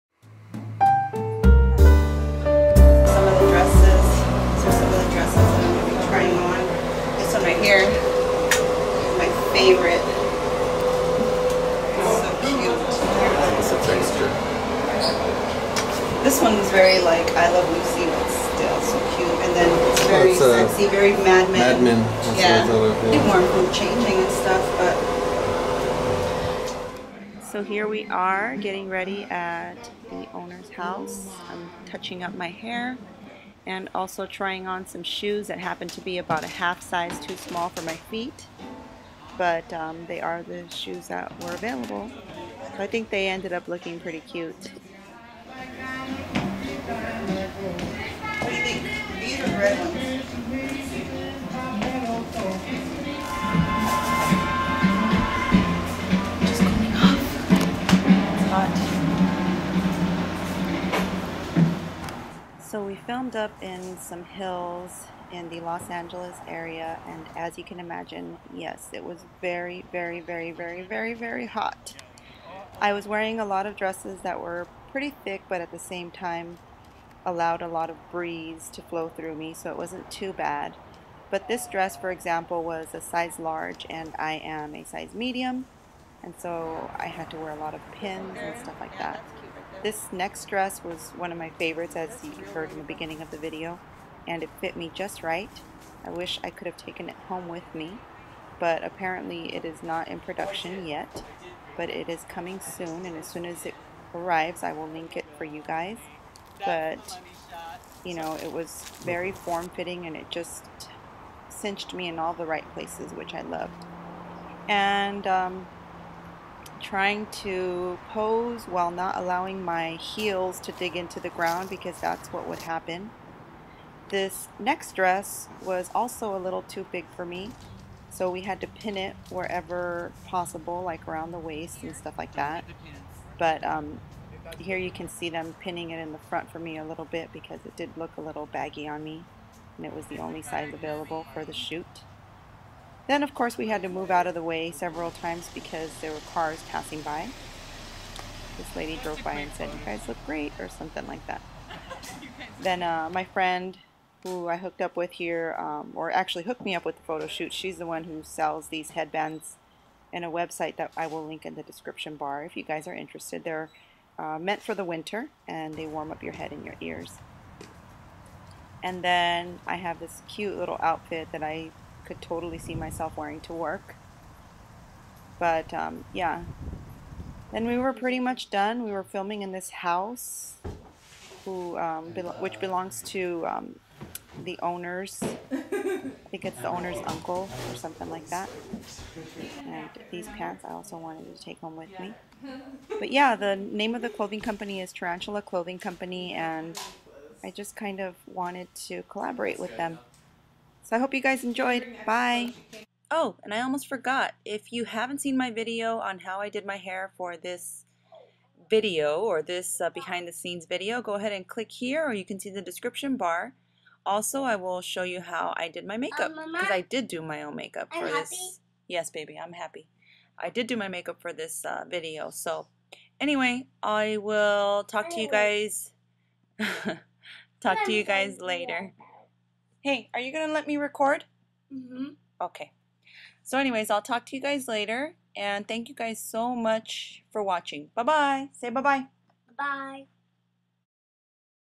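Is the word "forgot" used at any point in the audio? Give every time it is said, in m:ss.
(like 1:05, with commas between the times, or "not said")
3:23.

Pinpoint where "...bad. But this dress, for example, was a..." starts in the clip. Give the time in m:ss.
1:20.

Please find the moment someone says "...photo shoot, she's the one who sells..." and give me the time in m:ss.
2:37.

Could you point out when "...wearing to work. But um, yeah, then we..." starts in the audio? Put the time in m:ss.
2:53.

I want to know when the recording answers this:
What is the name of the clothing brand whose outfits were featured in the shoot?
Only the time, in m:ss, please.
3:14.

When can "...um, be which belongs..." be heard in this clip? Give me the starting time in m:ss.
3:01.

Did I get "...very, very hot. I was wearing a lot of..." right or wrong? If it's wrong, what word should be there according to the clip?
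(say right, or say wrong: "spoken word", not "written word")
right.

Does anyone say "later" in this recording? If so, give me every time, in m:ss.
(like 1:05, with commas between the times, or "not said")
3:48, 3:54.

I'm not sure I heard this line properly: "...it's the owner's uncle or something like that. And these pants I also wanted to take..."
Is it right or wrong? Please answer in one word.
right.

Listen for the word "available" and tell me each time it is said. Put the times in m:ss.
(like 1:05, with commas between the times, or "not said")
0:41, 2:20.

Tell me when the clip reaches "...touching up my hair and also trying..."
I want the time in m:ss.
0:31.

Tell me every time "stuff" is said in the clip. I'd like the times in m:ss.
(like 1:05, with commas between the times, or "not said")
0:24, 1:28, 2:11.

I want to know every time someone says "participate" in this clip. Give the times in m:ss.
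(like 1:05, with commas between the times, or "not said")
not said.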